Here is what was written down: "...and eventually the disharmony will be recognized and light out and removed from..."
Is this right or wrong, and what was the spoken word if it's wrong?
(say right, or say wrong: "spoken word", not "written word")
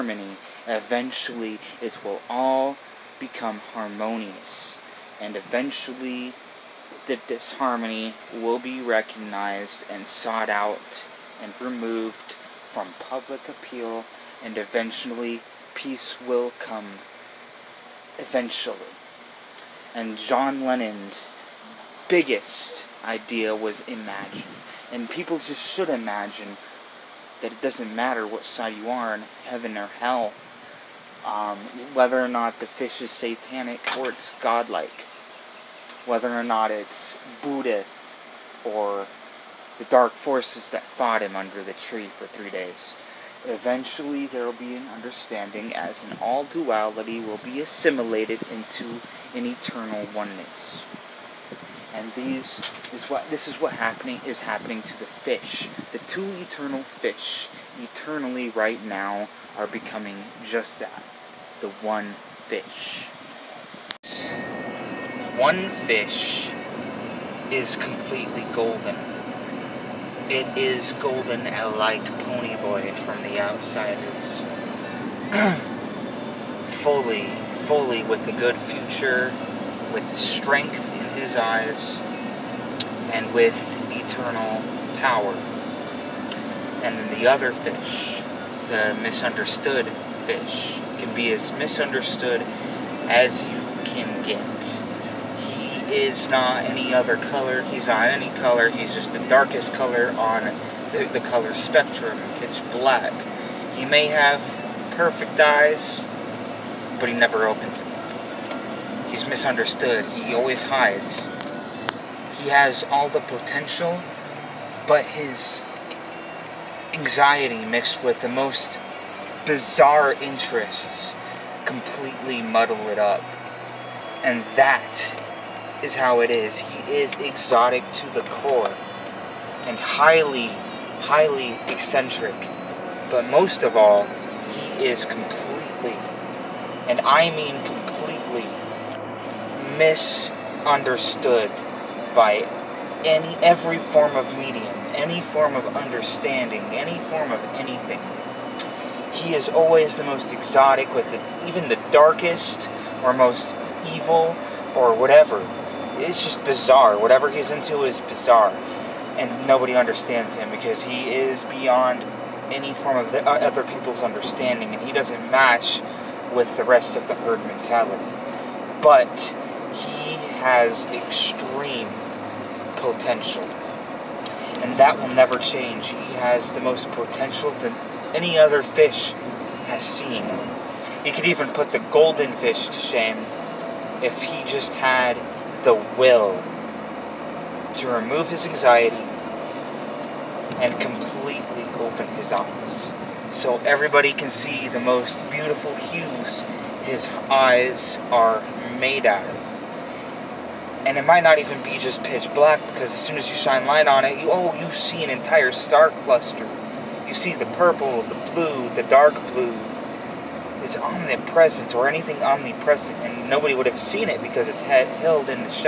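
wrong: "sought", not "light".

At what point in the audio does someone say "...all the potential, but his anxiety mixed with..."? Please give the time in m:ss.
1:52.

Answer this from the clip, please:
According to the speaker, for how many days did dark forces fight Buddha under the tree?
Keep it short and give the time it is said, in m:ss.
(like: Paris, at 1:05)
3, at 0:42.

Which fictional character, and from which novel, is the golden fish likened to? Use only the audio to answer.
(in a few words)
Ponyboy from The Outsiders.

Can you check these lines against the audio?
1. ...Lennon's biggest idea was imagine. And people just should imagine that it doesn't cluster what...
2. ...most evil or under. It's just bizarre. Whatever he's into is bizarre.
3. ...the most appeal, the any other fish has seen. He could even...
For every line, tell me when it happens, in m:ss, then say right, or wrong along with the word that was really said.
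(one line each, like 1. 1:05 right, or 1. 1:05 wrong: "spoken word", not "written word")
1. 0:20 wrong: "matter", not "cluster"
2. 2:33 wrong: "whatever", not "under"
3. 2:56 wrong: "potential", not "appeal".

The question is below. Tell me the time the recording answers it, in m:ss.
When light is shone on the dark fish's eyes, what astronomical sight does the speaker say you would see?
3:25.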